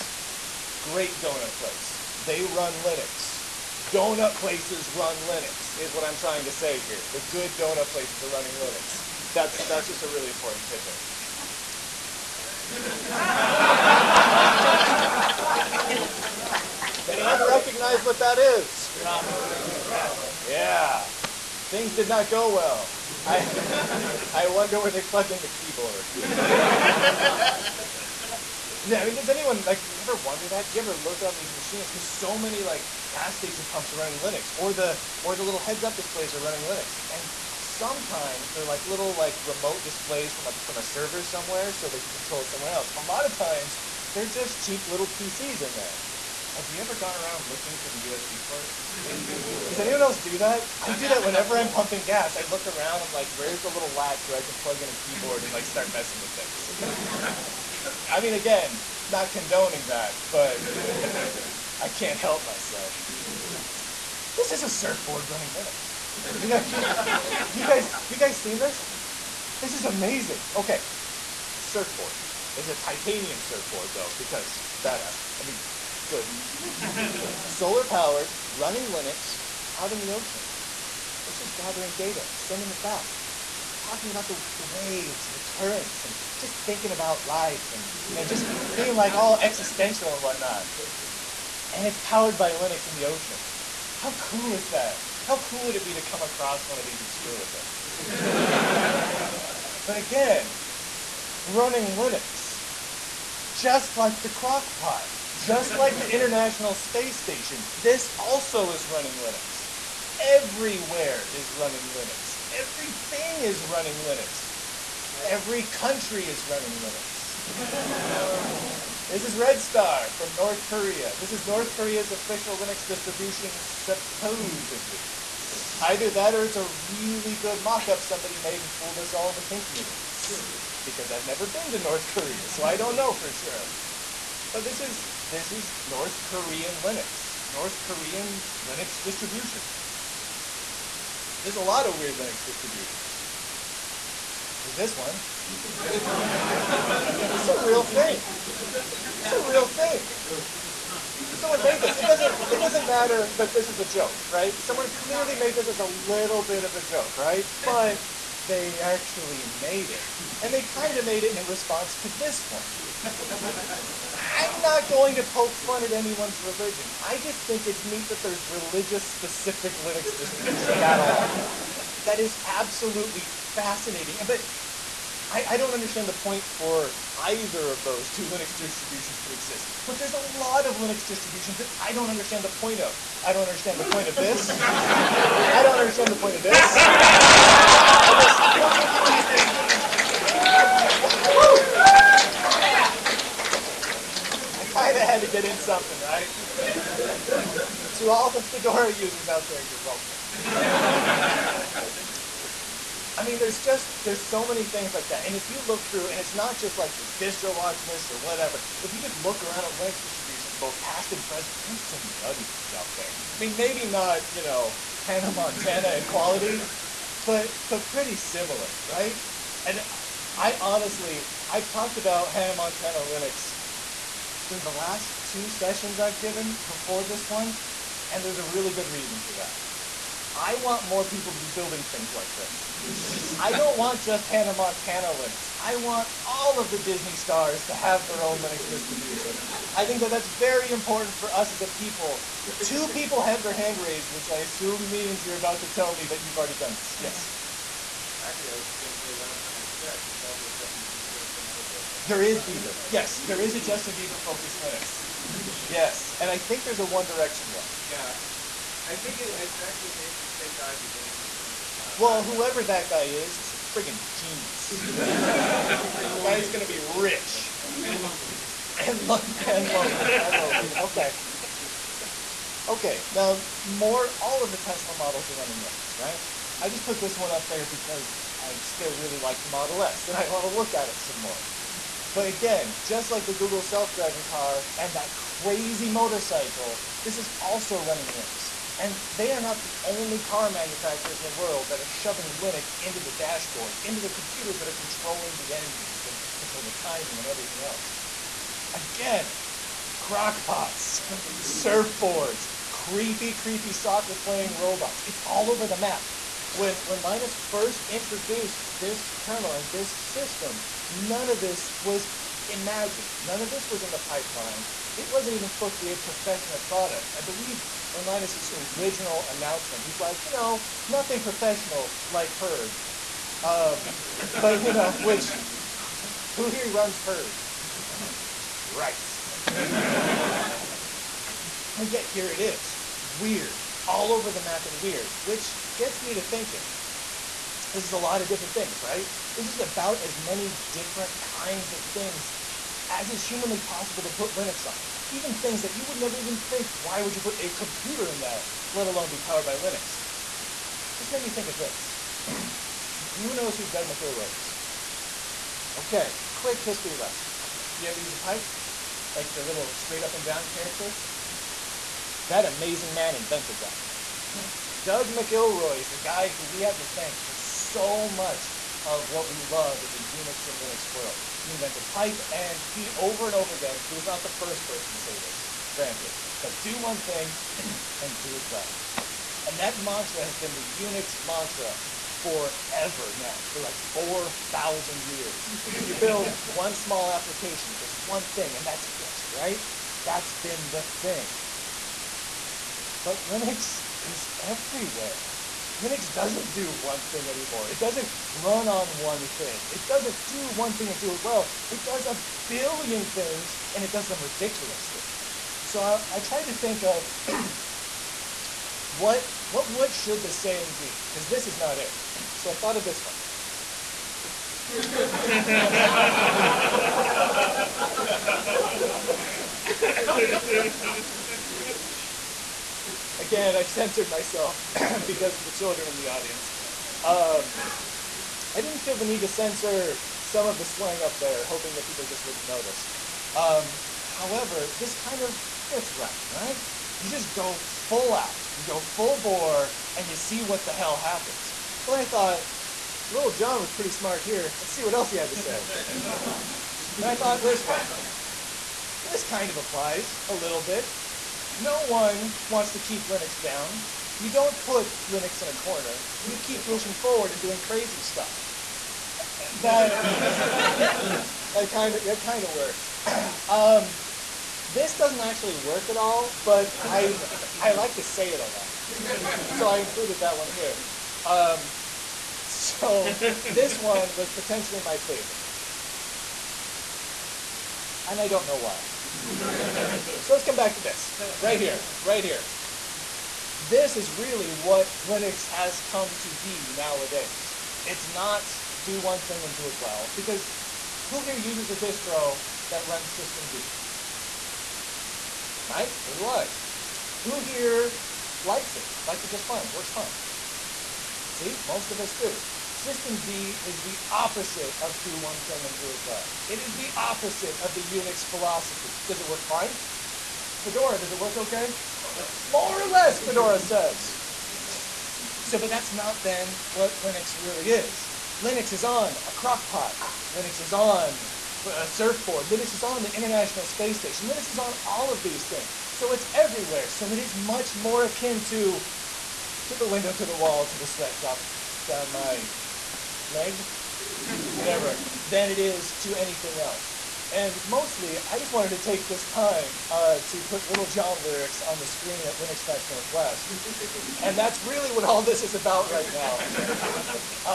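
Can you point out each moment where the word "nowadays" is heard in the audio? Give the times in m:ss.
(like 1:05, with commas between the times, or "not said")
8:06.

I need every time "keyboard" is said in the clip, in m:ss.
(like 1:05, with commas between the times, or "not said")
0:25, 0:54.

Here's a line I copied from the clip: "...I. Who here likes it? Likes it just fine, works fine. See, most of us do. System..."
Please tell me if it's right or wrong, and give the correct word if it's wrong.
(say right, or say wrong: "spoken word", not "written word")
right.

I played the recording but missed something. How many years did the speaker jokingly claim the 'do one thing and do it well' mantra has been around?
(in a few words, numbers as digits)
4,000.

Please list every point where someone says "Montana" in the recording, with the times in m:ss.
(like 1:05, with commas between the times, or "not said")
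3:35, 3:42, 3:54, 4:21.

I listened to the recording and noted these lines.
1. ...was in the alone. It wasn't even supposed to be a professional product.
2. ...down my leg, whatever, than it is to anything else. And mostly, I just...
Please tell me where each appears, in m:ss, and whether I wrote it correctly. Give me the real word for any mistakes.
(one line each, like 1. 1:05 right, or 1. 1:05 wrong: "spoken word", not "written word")
1. 5:13 wrong: "pipeline", not "alone"
2. 8:51 right.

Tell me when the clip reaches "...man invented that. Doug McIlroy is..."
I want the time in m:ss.
6:02.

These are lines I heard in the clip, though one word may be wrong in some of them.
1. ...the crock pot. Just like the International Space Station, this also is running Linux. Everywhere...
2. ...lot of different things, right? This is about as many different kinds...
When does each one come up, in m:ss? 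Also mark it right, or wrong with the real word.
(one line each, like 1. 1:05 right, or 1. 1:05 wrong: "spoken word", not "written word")
1. 1:44 right
2. 5:37 right.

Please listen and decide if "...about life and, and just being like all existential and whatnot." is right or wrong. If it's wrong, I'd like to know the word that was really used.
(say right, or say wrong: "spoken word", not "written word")
right.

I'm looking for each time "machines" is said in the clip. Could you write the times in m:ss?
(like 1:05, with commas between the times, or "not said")
0:31.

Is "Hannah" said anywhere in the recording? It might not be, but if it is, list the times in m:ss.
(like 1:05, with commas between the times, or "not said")
3:35, 3:42, 3:54, 4:21.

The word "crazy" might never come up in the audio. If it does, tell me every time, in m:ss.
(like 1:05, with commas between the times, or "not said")
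4:45, 7:37.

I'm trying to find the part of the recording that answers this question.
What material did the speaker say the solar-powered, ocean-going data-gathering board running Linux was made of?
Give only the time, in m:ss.
1:12.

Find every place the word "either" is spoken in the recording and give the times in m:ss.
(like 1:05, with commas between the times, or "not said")
2:05, 2:57.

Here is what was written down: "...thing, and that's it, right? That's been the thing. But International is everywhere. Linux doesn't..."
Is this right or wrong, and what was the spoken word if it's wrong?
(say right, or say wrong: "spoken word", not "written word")
wrong: "Linux", not "International".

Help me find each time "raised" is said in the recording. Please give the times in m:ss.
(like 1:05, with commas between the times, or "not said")
4:03.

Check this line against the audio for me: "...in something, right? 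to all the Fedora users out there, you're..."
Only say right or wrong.
right.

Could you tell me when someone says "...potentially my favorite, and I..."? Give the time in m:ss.
7:54.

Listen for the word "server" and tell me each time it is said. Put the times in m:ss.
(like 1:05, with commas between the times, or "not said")
0:40.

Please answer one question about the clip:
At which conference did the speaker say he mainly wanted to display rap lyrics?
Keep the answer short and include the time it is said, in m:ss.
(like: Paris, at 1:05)
LinuxFest Northwest, at 9:02.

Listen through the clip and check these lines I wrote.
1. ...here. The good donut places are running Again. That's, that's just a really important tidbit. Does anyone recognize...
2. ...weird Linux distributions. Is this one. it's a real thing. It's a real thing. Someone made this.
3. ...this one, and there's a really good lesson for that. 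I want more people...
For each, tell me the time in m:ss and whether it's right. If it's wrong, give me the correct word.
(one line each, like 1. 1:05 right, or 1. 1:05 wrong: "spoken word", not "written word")
1. 0:06 wrong: "Linux", not "Again"
2. 2:21 right
3. 3:47 wrong: "reason", not "lesson".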